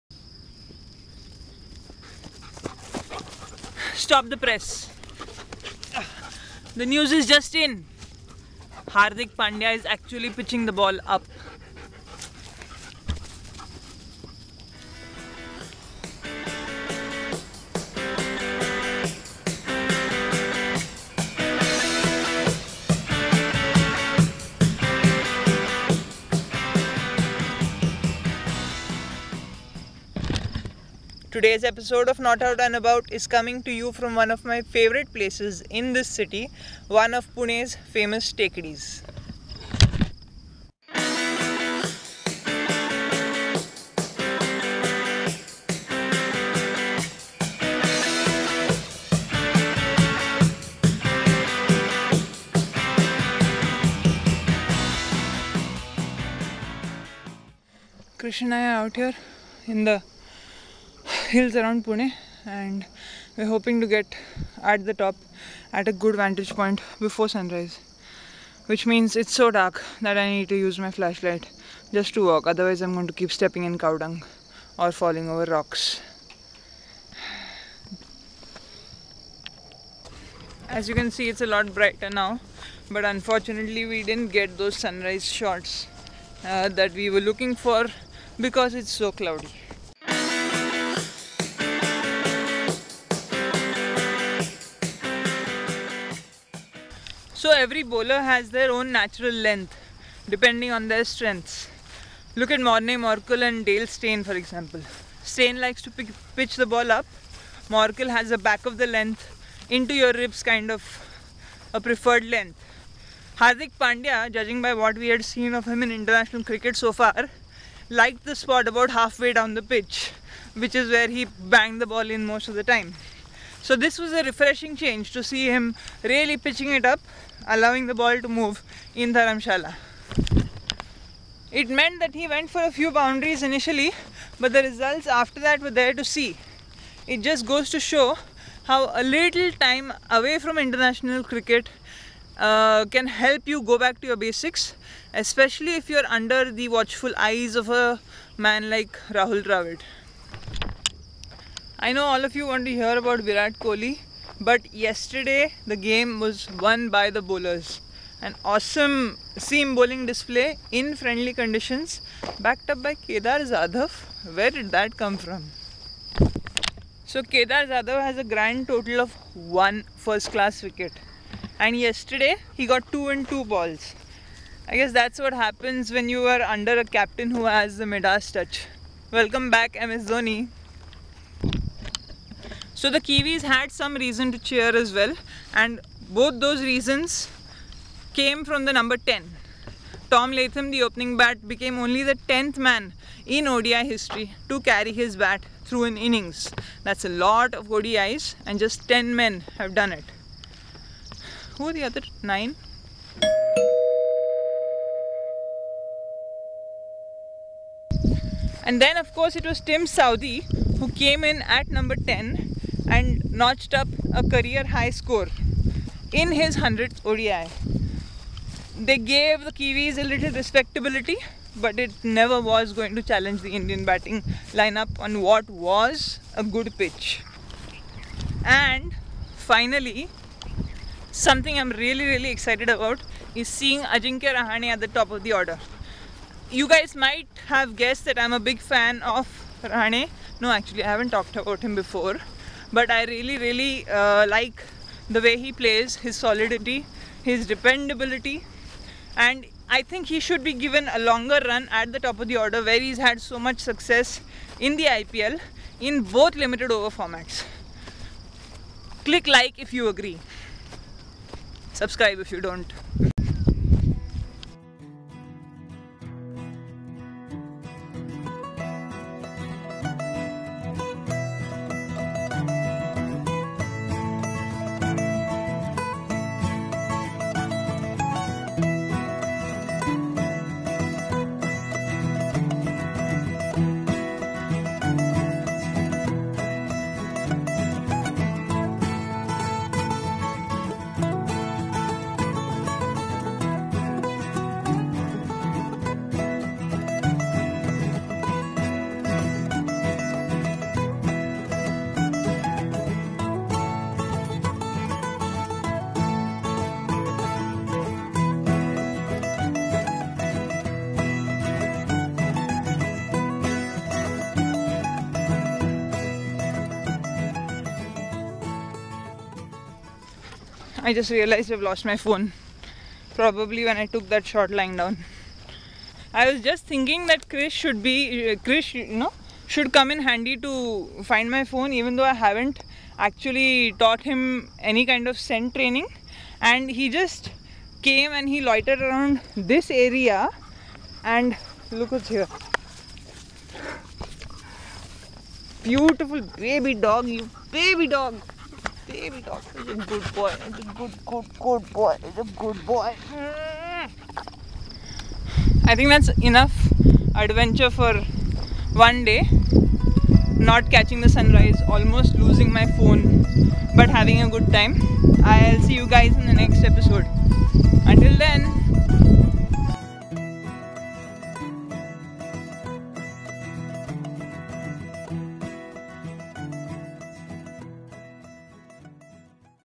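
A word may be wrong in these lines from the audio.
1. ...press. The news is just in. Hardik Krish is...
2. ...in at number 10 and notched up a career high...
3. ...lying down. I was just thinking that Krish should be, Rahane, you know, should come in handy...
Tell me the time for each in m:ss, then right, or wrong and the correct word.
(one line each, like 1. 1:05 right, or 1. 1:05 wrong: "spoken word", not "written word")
1. 0:04 wrong: "Pandya", not "Krish"
2. 3:31 right
3. 5:24 wrong: "Krish", not "Rahane".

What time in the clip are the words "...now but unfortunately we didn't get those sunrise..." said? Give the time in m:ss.
1:22.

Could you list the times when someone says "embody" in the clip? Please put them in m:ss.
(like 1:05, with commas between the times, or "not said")
not said.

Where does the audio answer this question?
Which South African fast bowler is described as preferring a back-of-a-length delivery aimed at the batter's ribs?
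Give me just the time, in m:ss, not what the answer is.
1:42.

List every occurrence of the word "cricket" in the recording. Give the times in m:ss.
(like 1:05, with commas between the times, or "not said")
1:56, 2:21.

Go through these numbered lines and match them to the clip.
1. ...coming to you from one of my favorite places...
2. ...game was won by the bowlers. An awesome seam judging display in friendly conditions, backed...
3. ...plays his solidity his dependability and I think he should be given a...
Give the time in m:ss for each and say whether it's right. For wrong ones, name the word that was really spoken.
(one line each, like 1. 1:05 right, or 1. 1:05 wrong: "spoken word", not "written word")
1. 0:33 right
2. 2:35 wrong: "bowling", not "judging"
3. 4:05 right.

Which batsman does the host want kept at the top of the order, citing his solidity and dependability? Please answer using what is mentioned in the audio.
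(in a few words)
Ajinkya Rahane.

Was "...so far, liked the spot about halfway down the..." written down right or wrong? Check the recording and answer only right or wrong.
right.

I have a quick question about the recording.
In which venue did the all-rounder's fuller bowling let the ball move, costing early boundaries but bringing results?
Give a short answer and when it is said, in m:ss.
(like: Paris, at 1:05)
Dharamshala, at 2:09.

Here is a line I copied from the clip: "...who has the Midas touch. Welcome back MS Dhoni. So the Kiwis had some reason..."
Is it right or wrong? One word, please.
right.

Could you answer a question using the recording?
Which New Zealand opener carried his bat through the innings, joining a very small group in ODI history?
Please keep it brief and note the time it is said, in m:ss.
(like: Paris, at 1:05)
Tom Latham, at 3:10.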